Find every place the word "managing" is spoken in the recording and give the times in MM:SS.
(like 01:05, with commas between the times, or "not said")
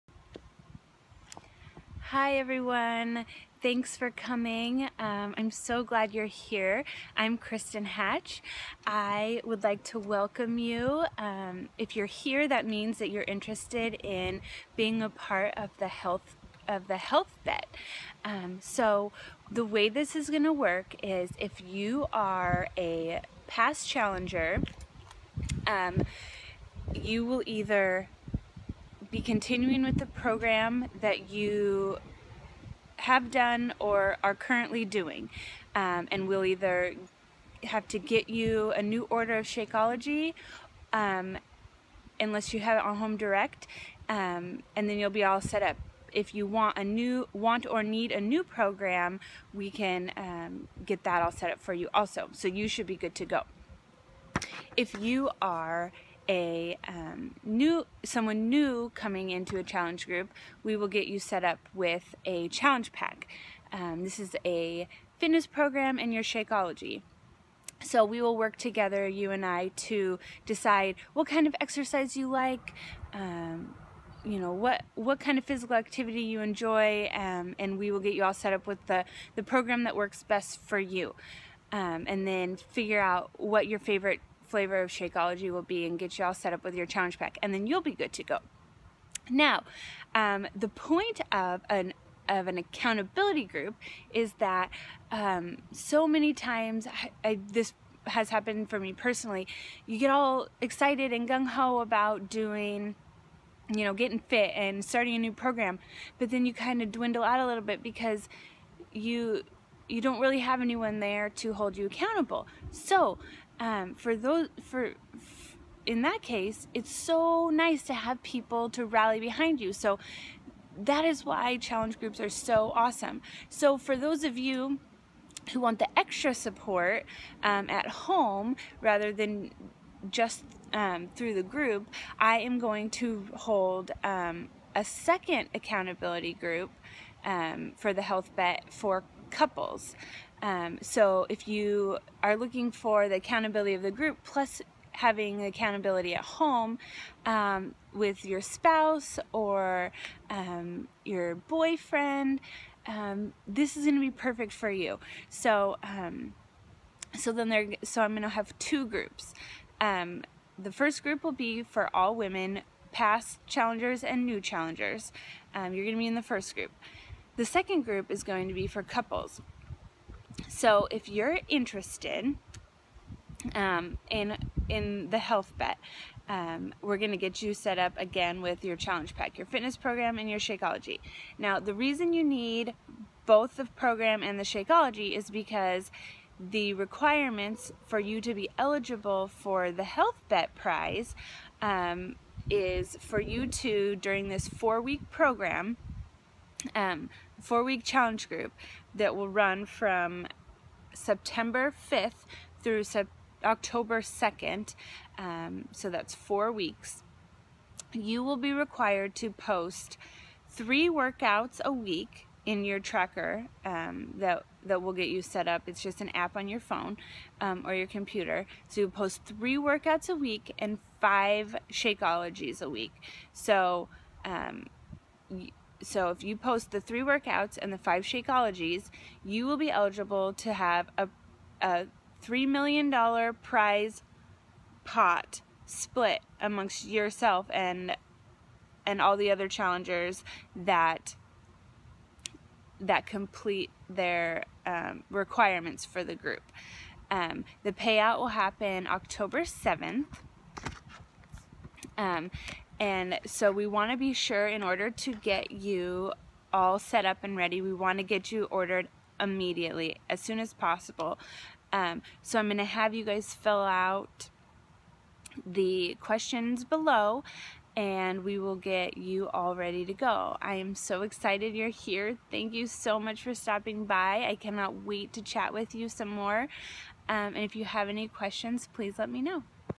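not said.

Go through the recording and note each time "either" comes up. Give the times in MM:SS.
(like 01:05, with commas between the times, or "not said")
00:27, 00:36.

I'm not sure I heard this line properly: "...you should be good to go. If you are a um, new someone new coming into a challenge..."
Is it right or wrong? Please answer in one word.
right.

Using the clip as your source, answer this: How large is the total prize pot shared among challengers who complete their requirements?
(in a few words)
$3 million.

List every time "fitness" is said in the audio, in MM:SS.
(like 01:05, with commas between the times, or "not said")
01:05, 02:59.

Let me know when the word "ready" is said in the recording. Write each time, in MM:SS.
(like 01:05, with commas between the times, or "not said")
04:17, 04:29.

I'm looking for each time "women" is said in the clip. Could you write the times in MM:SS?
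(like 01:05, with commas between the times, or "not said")
02:42.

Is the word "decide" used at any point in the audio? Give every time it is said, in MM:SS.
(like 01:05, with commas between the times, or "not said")
01:10.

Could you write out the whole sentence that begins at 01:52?
So um, for those for in that case, it's so nice to have people to rally behind you.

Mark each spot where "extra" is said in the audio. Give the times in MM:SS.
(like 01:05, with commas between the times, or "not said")
02:05.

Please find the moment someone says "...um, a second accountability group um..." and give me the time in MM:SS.
02:14.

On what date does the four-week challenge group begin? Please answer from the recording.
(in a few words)
September 5th.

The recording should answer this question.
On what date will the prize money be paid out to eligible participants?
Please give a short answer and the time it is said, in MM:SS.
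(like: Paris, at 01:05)
October 7th, at 04:08.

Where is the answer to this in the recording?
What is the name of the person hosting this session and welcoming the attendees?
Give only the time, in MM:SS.
00:07.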